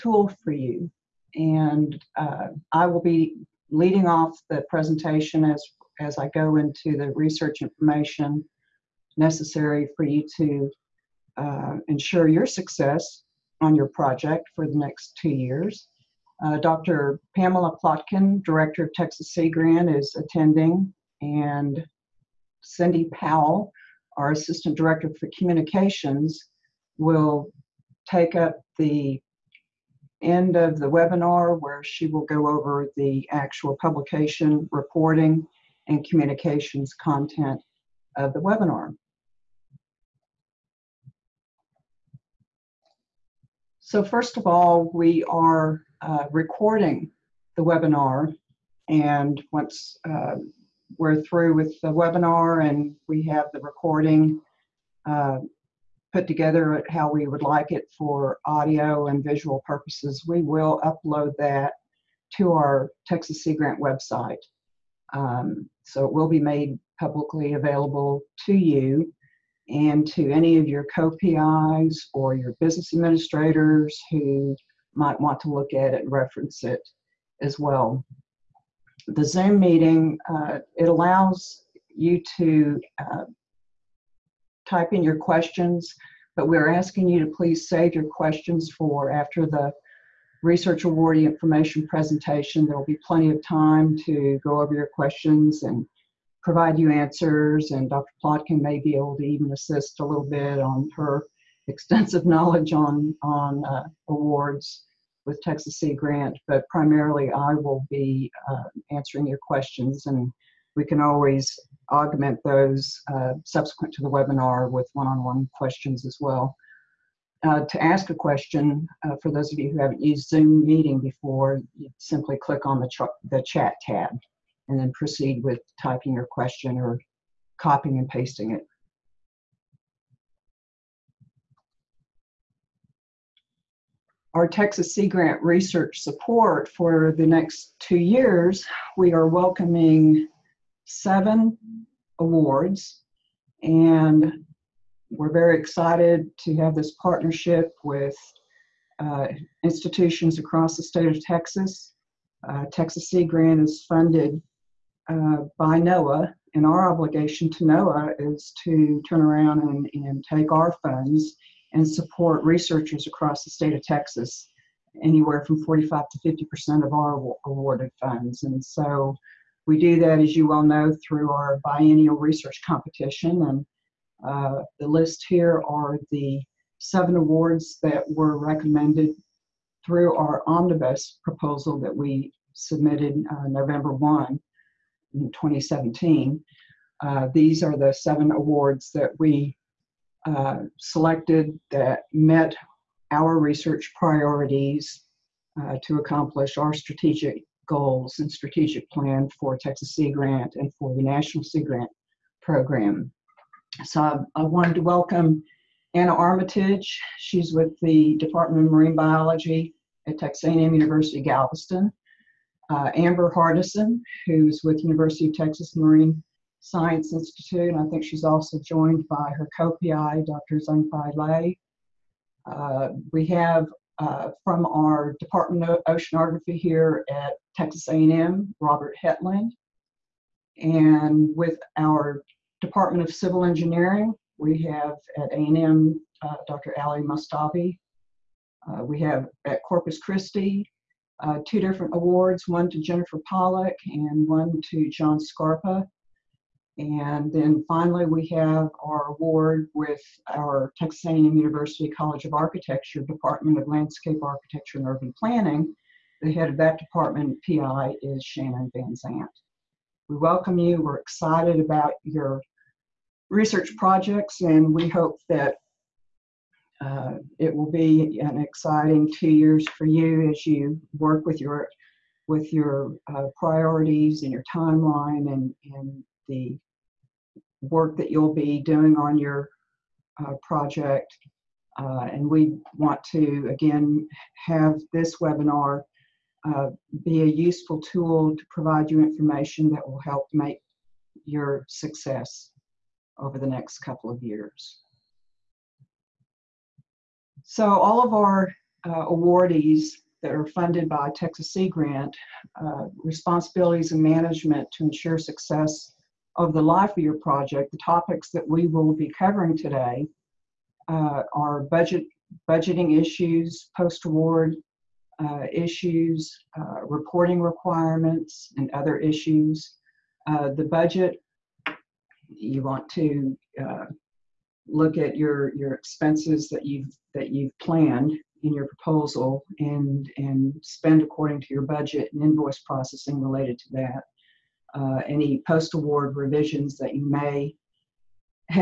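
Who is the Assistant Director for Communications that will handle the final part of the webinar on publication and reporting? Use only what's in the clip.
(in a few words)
Cindy Powell.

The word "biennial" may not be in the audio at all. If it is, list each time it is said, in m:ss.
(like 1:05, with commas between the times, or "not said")
2:51.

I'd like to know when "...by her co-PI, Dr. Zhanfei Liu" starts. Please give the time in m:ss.
3:39.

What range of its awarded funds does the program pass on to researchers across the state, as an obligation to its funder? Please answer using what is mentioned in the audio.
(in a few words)
45 to 50 percent.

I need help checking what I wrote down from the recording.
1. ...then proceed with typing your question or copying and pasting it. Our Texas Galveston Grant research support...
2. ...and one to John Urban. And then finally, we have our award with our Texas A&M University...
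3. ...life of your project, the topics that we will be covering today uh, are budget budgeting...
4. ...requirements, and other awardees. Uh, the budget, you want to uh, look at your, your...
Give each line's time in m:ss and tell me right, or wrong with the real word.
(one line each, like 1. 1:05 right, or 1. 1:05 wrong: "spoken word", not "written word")
1. 2:04 wrong: "Sea", not "Galveston"
2. 4:03 wrong: "Scarpa", not "Urban"
3. 5:06 right
4. 5:17 wrong: "issues", not "awardees".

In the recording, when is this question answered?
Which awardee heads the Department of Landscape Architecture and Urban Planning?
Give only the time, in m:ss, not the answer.
4:18.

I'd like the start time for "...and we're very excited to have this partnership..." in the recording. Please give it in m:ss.
2:23.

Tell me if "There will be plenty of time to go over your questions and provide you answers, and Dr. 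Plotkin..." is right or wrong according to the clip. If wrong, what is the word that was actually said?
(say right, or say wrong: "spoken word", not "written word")
right.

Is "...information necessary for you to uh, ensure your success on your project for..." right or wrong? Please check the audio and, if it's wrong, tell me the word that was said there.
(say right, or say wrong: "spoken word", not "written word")
right.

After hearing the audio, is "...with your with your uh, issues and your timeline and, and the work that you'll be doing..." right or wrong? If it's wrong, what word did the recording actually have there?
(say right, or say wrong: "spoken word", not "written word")
wrong: "priorities", not "issues".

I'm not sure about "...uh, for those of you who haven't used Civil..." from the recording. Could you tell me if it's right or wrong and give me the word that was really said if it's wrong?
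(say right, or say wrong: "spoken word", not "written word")
wrong: "Zoom", not "Civil".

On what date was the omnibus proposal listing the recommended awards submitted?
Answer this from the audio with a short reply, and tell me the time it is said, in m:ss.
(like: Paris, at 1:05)
November 1, 2017, at 3:03.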